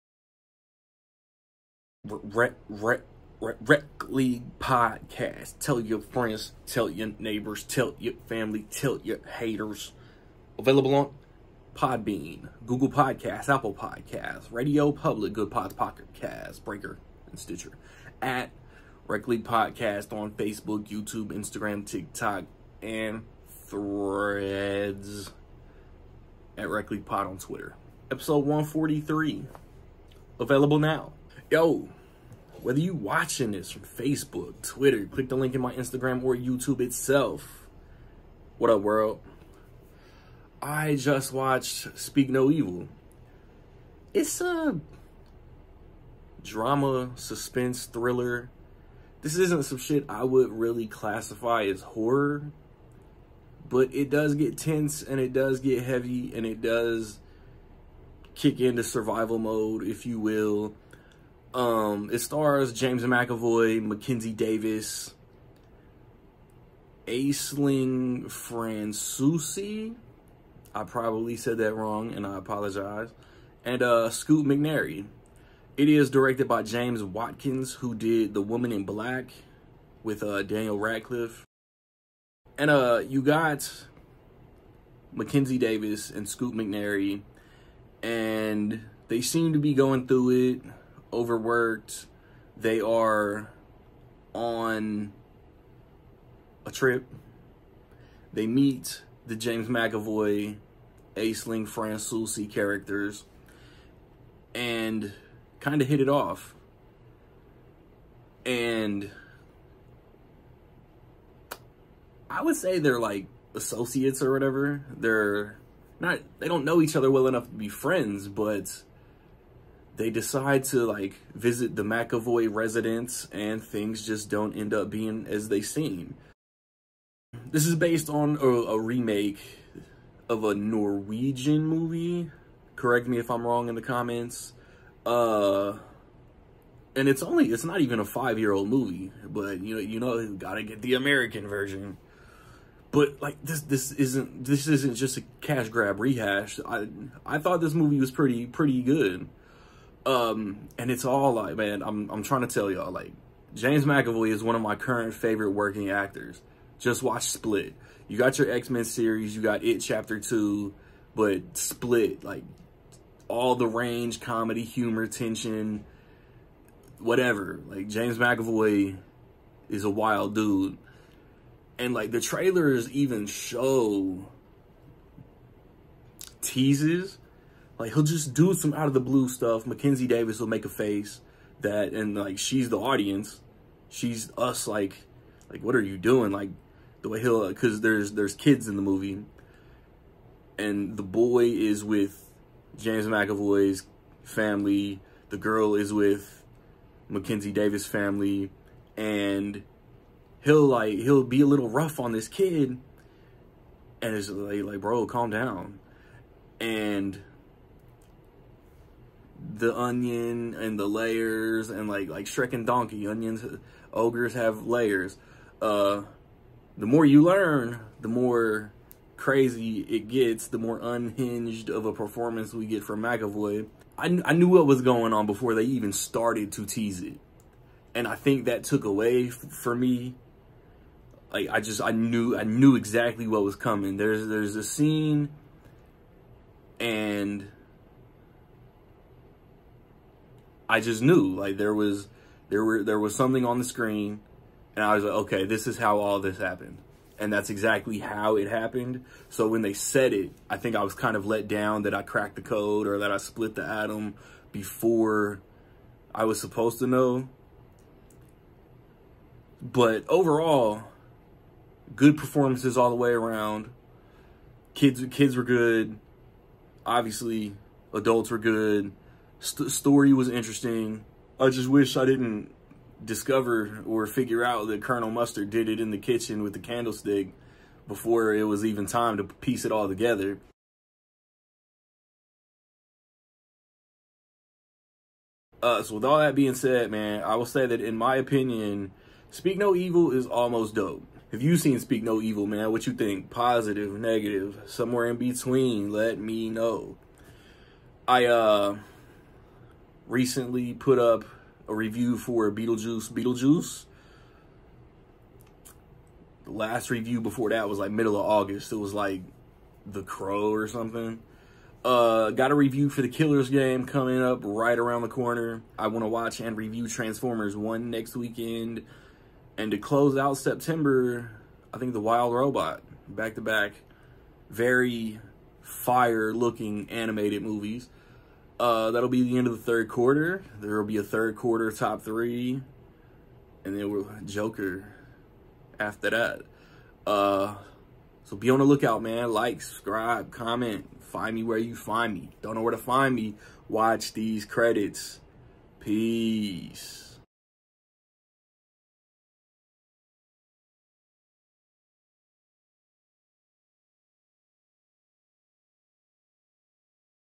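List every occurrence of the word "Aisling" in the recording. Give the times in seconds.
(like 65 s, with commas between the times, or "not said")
67 s, 101 s.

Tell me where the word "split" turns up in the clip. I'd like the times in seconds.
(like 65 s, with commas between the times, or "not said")
157 s, 161 s, 253 s.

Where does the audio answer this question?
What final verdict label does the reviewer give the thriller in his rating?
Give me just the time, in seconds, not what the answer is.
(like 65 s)
290 s.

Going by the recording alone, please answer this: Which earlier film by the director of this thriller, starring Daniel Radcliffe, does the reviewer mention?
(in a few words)
The Woman in Black.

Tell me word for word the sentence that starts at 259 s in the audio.
But overall, good performances all the way around.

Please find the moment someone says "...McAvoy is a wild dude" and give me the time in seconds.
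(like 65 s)
168 s.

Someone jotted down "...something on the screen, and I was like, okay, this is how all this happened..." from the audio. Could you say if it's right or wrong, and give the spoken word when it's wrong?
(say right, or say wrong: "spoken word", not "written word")
right.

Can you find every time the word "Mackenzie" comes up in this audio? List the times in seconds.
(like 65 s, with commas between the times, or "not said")
63 s, 85 s, 179 s, 197 s.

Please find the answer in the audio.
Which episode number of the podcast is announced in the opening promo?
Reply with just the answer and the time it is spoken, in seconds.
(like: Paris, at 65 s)
143, at 28 s.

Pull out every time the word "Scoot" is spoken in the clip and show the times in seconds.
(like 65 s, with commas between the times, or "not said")
74 s, 86 s.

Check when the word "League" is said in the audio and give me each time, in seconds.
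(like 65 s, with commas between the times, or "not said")
4 s, 19 s, 26 s.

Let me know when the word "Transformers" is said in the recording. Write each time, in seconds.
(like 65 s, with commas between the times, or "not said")
316 s.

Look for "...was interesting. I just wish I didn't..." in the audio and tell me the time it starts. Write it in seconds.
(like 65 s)
270 s.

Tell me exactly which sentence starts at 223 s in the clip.
I, kn I knew what was going on before they even started to tease it.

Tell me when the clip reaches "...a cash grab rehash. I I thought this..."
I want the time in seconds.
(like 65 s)
145 s.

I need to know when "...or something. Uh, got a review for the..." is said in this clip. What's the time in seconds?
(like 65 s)
310 s.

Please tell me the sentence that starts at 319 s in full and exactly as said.
And to close out September, I think The Wild Robot, back to back.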